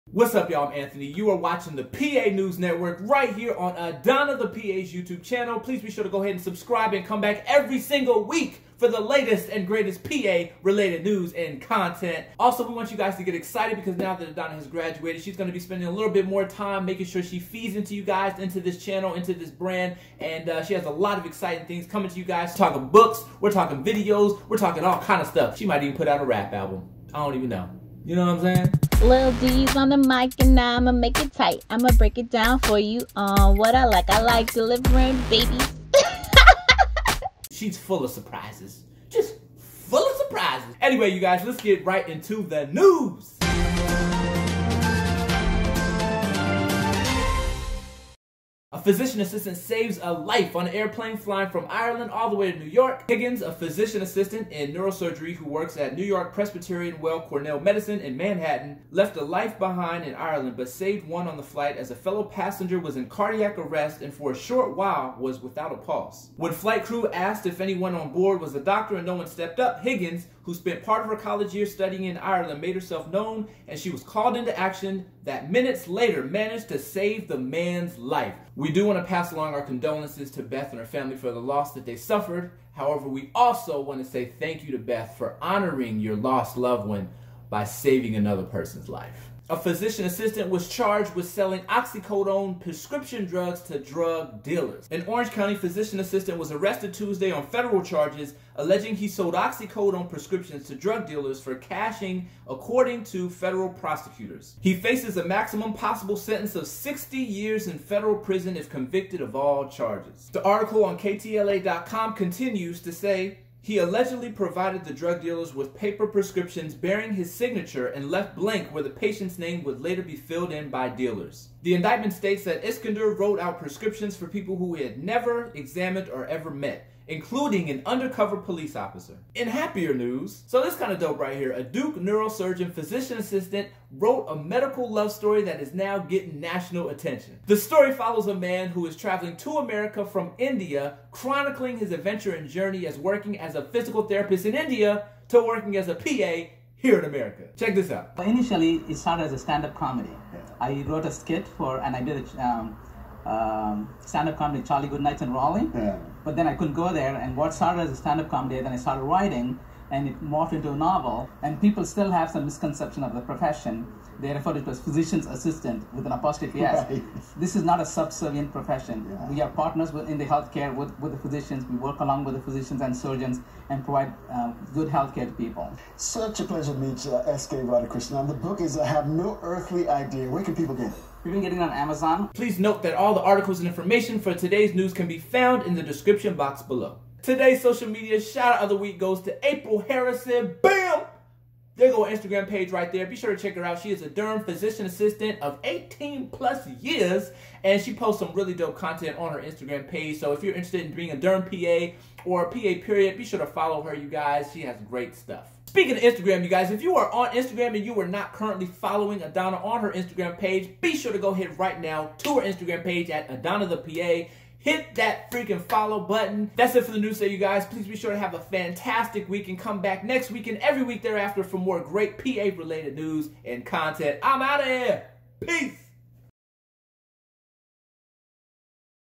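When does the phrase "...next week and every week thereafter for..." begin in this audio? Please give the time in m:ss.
3:40.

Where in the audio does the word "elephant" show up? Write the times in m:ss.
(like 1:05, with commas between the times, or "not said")
not said.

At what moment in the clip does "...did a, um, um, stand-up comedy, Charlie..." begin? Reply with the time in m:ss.
2:32.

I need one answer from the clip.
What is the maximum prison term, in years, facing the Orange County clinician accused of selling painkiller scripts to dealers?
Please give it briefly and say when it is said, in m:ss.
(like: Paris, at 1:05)
60, at 1:46.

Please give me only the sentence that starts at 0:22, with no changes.
We're talking books, we're talking videos, we're talking all kind of stuff.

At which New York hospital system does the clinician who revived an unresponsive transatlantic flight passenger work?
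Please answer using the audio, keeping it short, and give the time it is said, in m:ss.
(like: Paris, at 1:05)
New York Presbyterian Weill Cornell Medicine, at 0:55.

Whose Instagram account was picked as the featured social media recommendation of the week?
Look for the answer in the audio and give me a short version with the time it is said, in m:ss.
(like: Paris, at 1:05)
April Harrison, at 3:09.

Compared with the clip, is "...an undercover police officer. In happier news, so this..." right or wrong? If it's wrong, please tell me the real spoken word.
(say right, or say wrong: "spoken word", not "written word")
right.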